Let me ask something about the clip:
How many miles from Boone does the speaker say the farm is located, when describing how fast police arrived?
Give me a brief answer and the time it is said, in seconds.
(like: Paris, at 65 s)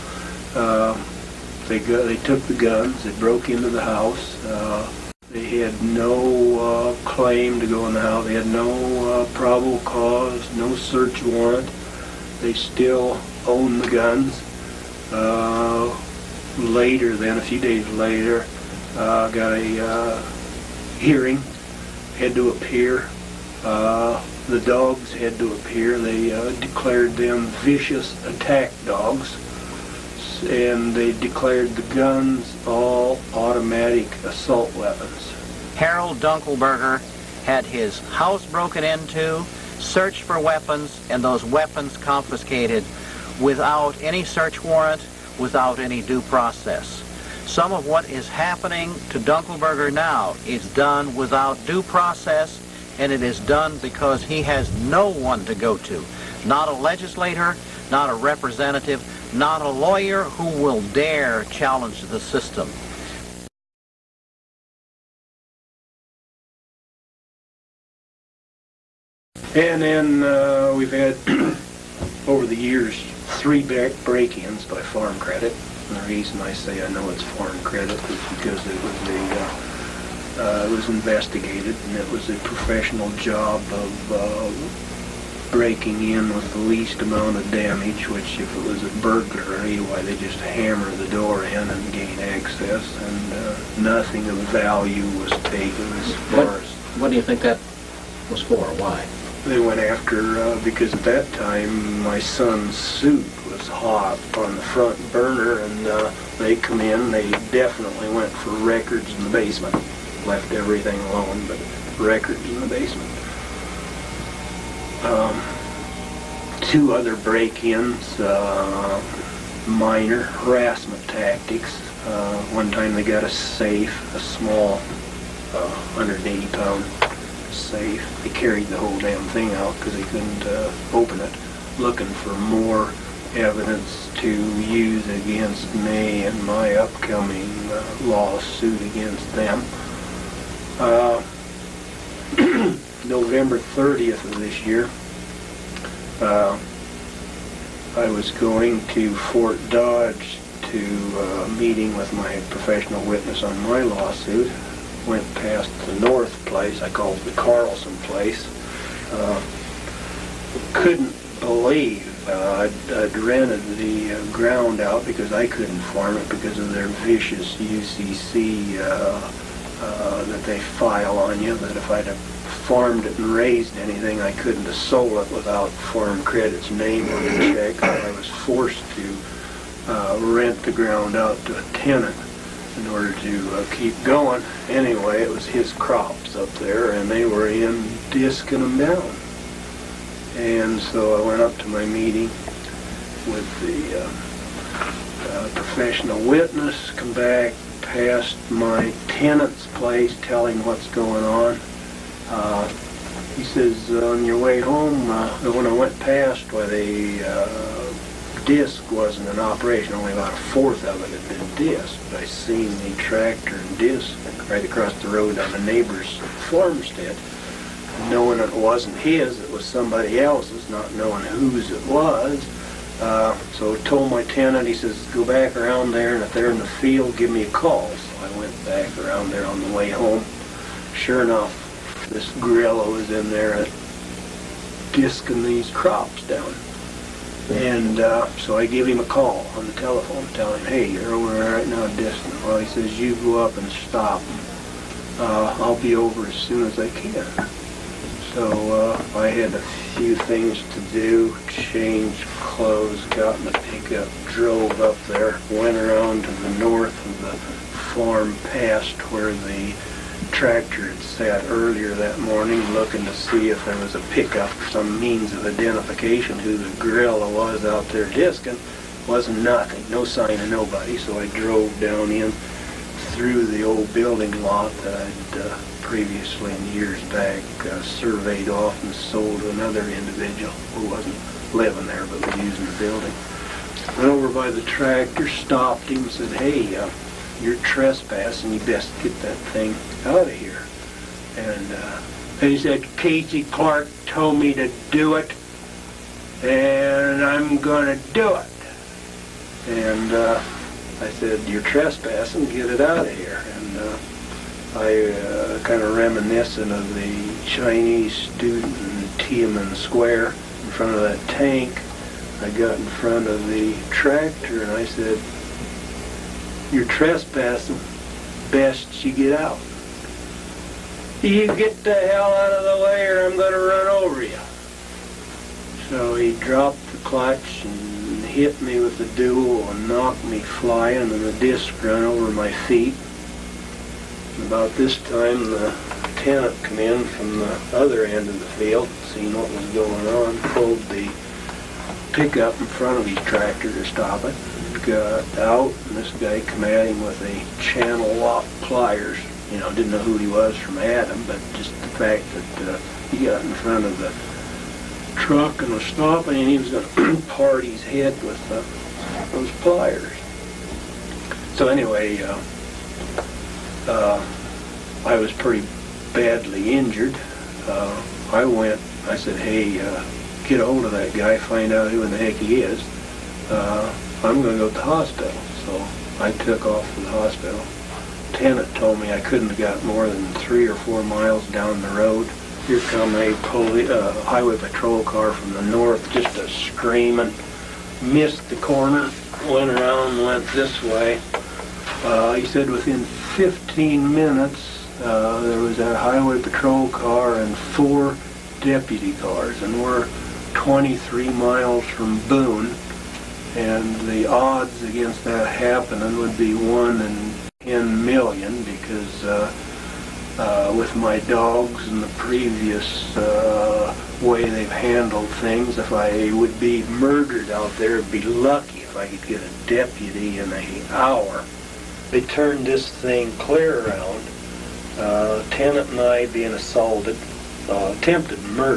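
23, at 400 s.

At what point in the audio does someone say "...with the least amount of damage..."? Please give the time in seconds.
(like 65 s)
86 s.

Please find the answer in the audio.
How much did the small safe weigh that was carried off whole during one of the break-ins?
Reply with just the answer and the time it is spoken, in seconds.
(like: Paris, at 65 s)
180 pounds, at 124 s.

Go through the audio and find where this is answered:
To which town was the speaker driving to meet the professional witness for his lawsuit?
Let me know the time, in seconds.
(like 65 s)
149 s.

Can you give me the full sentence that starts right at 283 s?
Went over by the tractor, stopped him, said, hey, uh, you're trespassing.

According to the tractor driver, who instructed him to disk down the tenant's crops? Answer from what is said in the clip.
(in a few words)
Casey Clark.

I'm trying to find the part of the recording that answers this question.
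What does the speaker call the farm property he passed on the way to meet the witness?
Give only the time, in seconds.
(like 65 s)
157 s.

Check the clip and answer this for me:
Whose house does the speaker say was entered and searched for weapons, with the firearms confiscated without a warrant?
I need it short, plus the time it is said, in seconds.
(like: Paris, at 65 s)
Harold Dunkelberger, at 35 s.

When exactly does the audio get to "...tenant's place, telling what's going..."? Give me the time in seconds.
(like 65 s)
199 s.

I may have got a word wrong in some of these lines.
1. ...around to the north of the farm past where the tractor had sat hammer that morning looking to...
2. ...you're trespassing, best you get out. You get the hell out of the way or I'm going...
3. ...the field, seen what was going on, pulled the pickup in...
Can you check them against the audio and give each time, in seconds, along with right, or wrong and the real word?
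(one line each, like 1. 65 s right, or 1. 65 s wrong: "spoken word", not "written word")
1. 255 s wrong: "earlier", not "hammer"
2. 316 s right
3. 338 s right.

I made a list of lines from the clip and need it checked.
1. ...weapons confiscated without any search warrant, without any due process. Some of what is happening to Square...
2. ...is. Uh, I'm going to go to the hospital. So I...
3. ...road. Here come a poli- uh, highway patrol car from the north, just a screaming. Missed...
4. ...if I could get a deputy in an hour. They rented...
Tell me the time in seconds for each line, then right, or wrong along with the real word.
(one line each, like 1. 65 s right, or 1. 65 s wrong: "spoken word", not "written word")
1. 41 s wrong: "Dunkelberger", not "Square"
2. 372 s right
3. 381 s right
4. 418 s wrong: "turned", not "rented".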